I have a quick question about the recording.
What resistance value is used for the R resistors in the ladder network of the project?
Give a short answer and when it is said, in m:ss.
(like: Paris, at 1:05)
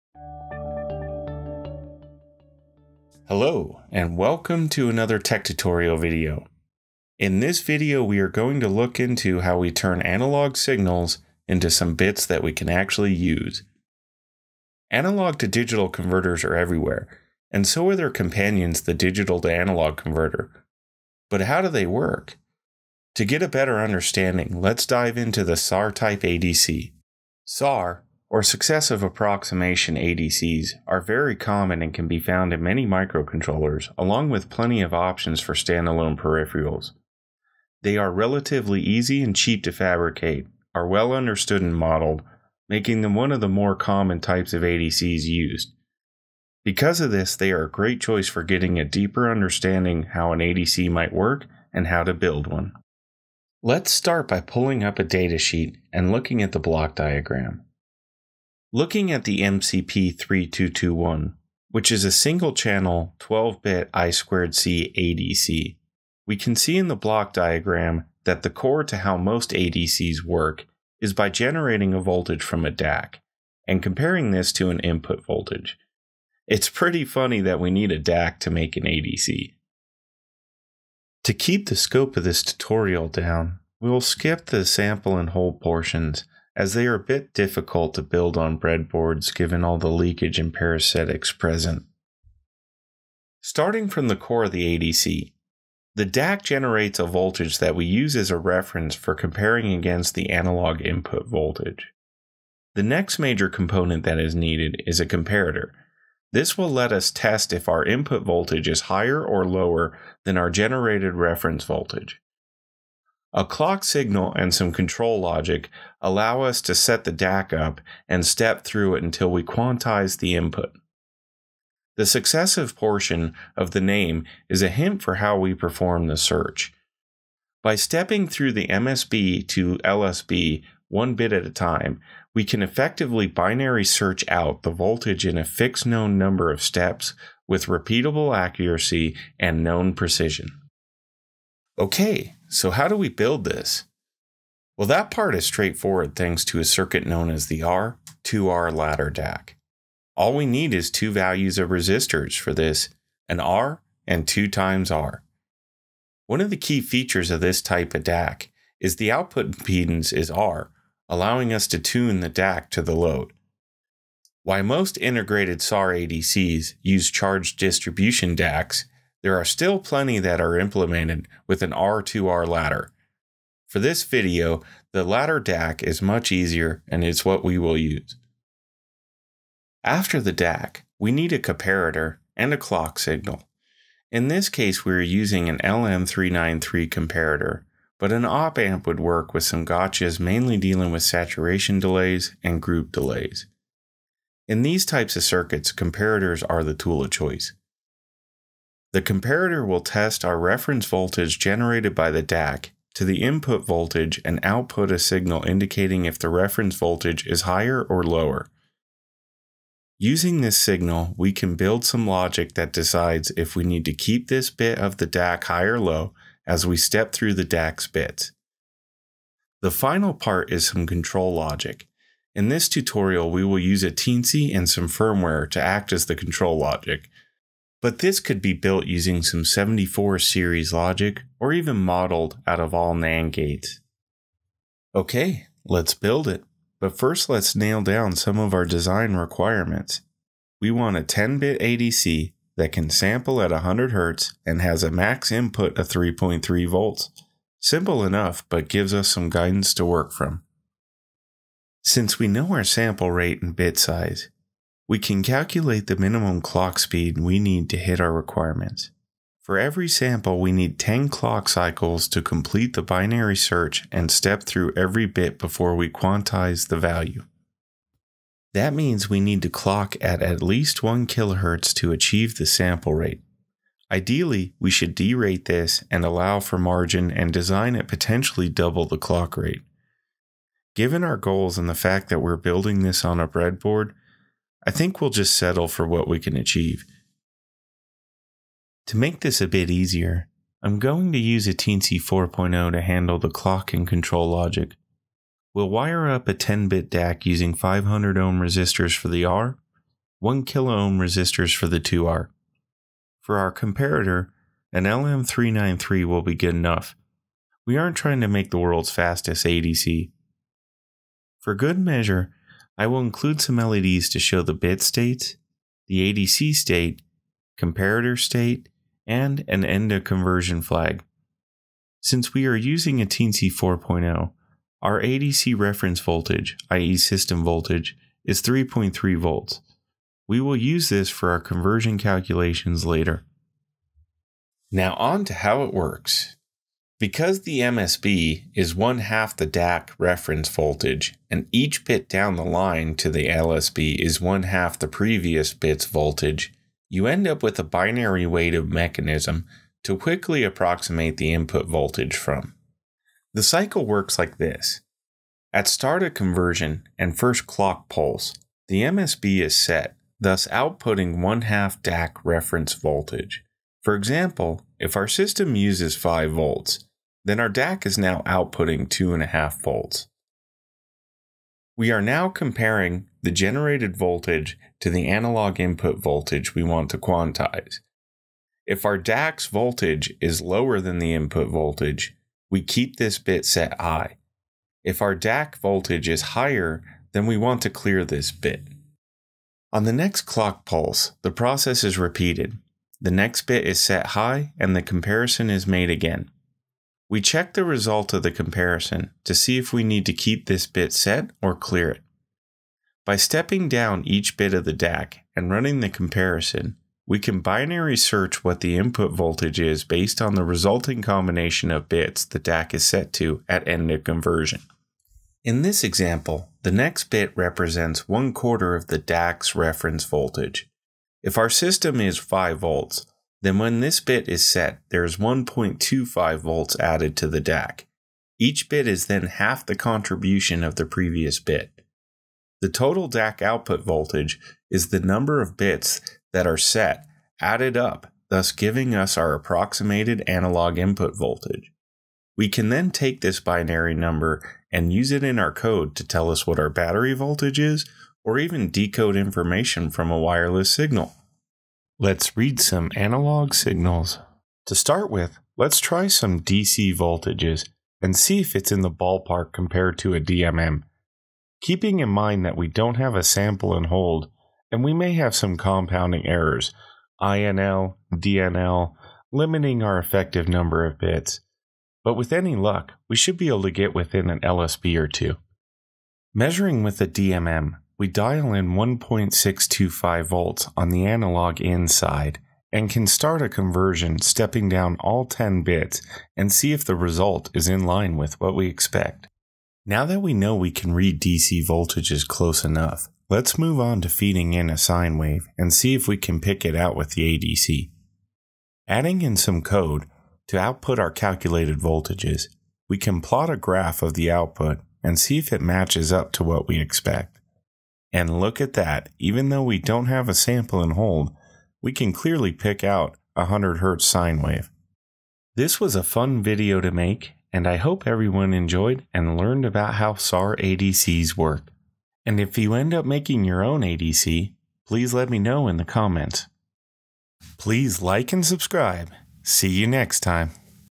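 500 ohms, at 4:57.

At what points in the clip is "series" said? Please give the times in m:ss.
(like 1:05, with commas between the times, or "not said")
3:50.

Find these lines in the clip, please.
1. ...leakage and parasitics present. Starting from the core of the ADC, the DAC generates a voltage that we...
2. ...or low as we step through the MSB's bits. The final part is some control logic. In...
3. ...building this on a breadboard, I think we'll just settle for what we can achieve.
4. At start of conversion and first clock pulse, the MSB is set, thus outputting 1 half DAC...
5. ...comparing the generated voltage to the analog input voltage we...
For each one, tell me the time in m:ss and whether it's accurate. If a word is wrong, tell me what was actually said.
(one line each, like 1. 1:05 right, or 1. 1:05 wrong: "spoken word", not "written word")
1. 1:29 right
2. 3:35 wrong: "DAC", not "MSB"
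3. 4:42 right
4. 5:55 right
5. 6:12 right.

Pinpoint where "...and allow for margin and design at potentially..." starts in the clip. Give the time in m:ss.
4:35.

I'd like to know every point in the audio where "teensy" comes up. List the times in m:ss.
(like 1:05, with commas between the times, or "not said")
3:43, 4:51, 5:23.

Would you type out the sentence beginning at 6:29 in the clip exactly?
On the next clock pulse, the process is repeated.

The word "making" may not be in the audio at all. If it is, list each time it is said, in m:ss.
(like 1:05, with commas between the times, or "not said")
0:42, 8:43.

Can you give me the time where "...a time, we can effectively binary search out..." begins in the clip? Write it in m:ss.
2:11.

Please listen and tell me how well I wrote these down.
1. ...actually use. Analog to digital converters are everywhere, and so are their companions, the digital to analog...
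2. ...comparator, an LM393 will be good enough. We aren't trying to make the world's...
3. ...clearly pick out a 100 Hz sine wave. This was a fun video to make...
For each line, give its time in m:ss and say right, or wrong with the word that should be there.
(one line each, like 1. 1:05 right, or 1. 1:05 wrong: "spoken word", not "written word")
1. 0:12 right
2. 5:03 right
3. 8:32 right.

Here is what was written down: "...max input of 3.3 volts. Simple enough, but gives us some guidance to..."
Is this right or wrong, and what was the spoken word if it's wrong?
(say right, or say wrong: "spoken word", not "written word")
right.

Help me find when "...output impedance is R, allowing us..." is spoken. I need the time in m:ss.
2:39.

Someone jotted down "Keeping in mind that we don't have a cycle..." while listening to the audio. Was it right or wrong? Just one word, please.
wrong.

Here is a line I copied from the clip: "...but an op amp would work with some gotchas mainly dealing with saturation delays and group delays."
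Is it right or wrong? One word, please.
right.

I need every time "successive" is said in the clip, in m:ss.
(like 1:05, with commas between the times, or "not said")
0:28, 2:02.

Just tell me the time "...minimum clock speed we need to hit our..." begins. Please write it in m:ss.
4:15.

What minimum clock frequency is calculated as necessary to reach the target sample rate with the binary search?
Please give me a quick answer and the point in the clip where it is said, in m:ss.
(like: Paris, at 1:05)
1 kilohertz, at 4:30.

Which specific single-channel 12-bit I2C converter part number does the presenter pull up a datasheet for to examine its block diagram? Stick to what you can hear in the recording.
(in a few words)
MCP3221.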